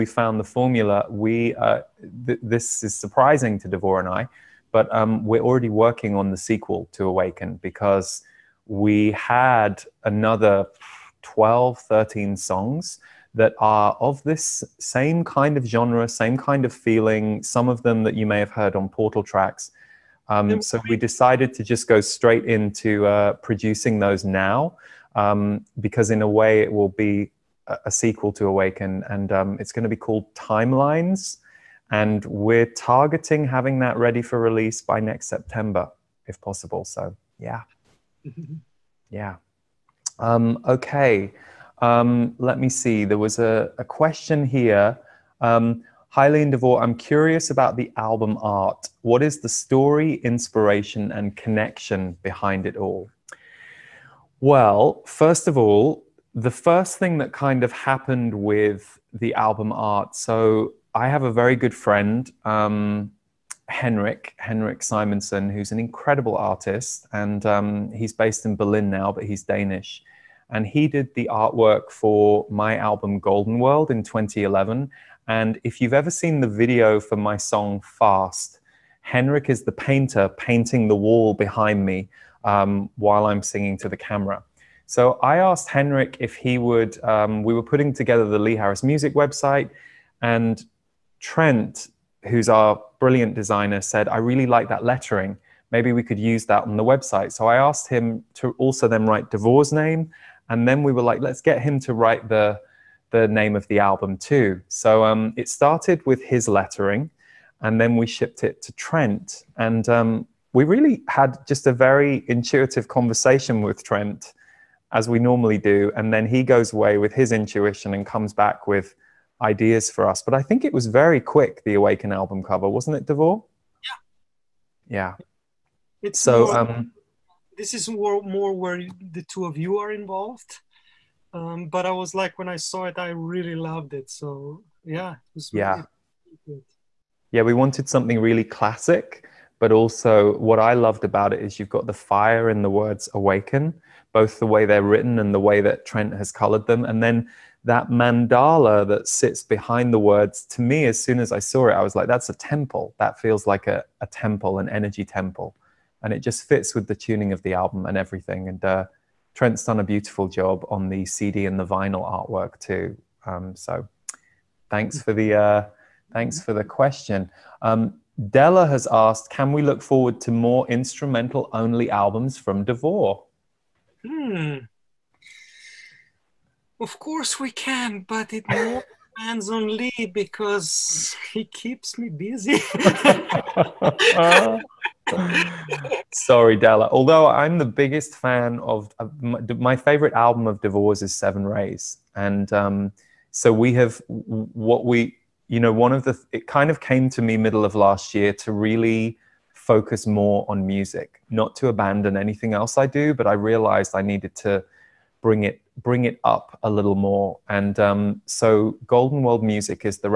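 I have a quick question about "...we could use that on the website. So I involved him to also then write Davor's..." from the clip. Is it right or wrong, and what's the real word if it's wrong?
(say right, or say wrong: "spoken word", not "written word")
wrong: "asked", not "involved".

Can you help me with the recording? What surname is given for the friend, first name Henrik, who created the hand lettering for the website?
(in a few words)
Simonson.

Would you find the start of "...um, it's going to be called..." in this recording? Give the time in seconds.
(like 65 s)
29 s.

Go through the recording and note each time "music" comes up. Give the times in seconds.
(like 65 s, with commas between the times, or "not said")
88 s, 200 s, 209 s.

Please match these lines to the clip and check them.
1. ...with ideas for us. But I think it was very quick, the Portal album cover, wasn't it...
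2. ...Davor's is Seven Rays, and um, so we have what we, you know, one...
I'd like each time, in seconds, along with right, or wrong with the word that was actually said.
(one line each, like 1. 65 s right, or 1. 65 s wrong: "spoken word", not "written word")
1. 118 s wrong: "Awaken", not "Portal"
2. 190 s right.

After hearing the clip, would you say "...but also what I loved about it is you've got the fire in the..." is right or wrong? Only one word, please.
right.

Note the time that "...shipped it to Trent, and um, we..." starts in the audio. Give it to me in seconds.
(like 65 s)
108 s.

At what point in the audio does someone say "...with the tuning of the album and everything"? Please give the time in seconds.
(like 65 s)
156 s.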